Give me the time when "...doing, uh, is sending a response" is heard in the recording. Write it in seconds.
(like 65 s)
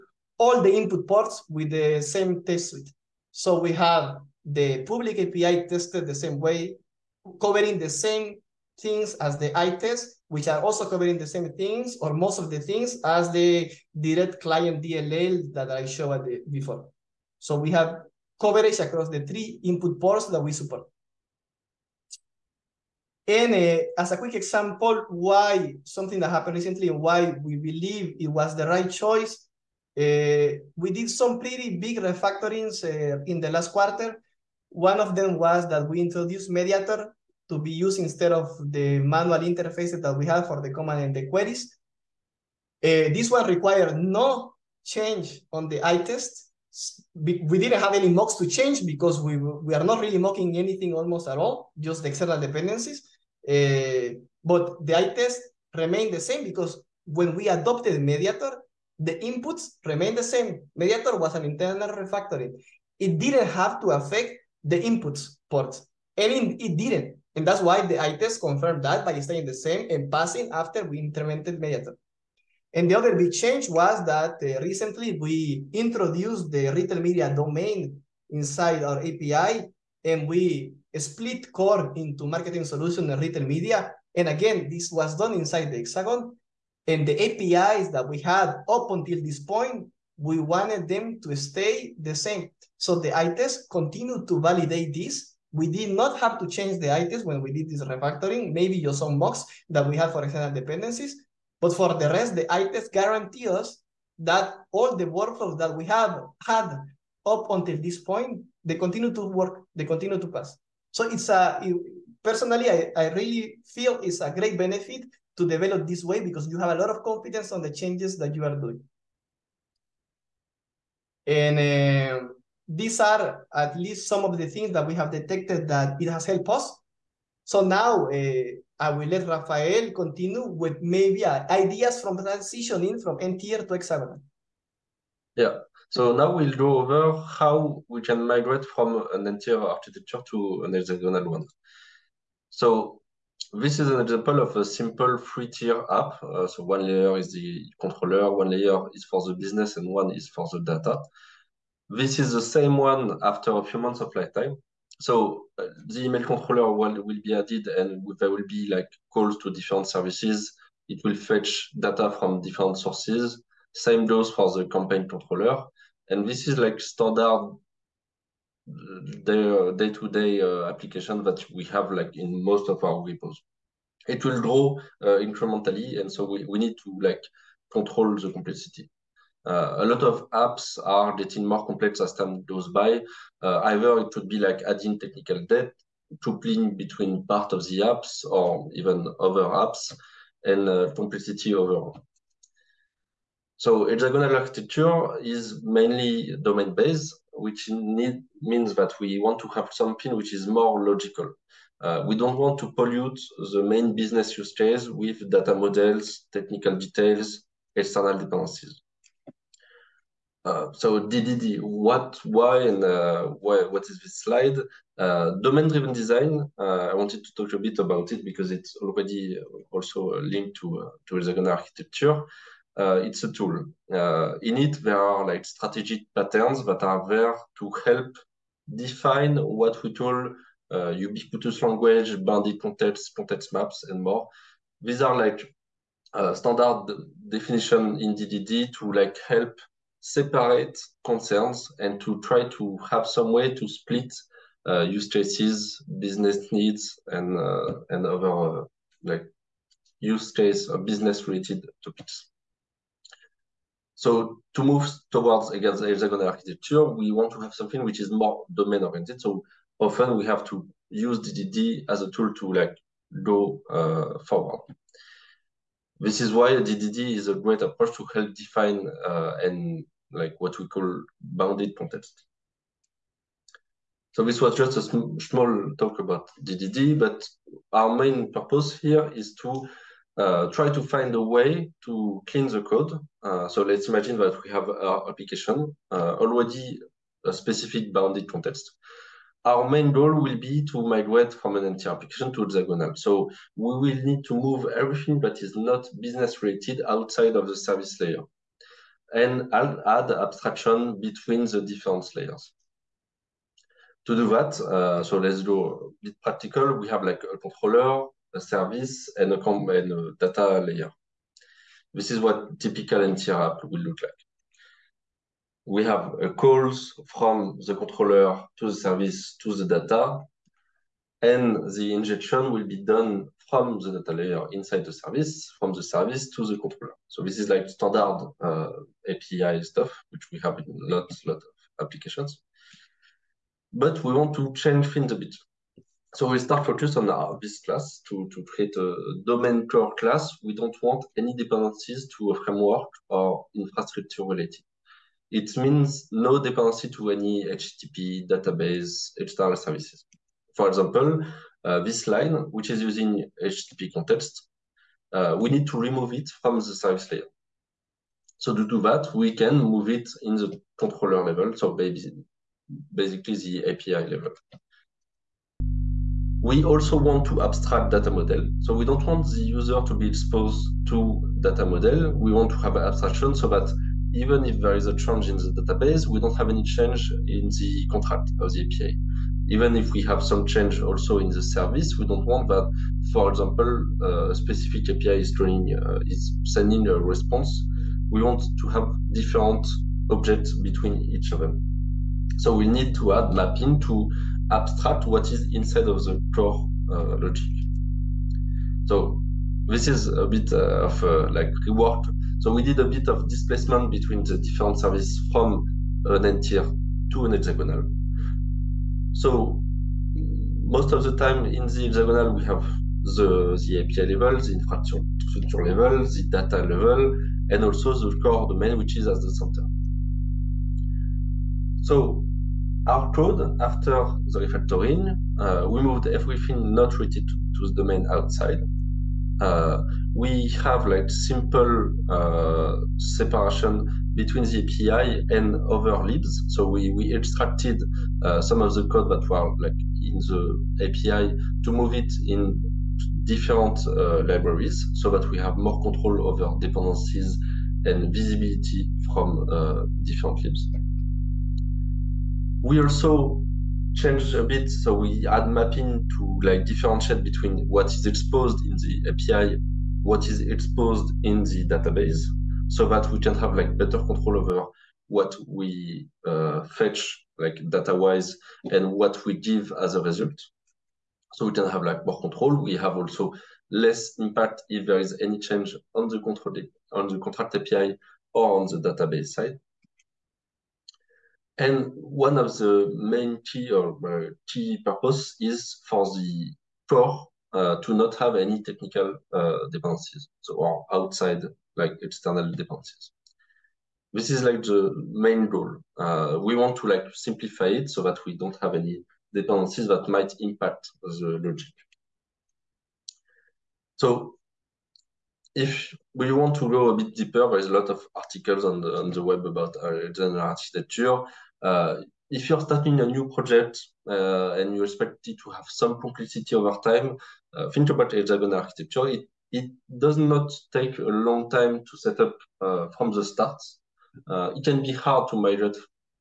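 385 s.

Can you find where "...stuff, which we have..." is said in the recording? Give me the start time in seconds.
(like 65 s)
329 s.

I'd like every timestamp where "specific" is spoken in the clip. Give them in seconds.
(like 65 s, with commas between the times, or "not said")
287 s, 384 s.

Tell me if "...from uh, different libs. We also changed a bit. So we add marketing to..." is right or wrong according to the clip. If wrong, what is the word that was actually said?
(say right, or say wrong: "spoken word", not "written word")
wrong: "mapping", not "marketing".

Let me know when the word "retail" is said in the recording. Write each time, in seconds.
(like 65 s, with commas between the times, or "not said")
76 s, 83 s.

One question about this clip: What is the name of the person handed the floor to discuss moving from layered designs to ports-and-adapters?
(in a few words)
Rafael.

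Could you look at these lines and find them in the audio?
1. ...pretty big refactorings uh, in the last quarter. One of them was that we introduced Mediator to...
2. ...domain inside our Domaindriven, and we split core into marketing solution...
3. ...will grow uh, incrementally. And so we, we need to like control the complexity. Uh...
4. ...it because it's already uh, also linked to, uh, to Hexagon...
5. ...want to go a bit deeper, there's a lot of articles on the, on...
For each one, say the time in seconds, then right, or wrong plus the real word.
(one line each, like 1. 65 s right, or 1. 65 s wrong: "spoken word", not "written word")
1. 31 s right
2. 77 s wrong: "API", not "Domaindriven"
3. 174 s right
4. 218 s right
5. 506 s right.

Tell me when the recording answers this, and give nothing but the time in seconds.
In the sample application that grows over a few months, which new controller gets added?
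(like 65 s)
155 s.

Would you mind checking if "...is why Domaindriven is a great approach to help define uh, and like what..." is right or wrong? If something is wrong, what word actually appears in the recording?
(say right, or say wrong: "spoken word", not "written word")
wrong: "DDD", not "Domaindriven".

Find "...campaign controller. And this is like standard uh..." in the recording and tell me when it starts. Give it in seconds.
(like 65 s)
164 s.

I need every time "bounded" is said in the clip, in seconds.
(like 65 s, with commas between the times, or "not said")
232 s, 271 s, 287 s.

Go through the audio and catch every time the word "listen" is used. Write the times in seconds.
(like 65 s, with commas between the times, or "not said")
not said.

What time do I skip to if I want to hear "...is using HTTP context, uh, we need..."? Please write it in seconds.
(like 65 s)
352 s.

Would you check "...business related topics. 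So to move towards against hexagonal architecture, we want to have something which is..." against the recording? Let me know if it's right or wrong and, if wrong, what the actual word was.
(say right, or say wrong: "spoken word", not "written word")
right.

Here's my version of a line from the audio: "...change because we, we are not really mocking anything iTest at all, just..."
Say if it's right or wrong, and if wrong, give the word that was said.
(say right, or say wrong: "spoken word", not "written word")
wrong: "almost", not "iTest".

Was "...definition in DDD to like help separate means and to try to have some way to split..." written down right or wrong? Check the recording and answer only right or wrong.
wrong.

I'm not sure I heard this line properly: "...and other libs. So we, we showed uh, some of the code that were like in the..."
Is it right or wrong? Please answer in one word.
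wrong.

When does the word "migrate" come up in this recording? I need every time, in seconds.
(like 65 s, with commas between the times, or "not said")
138 s, 290 s, 525 s.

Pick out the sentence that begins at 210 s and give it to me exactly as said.
Uh, so DDD, what, why, and uh, why, what is this slide?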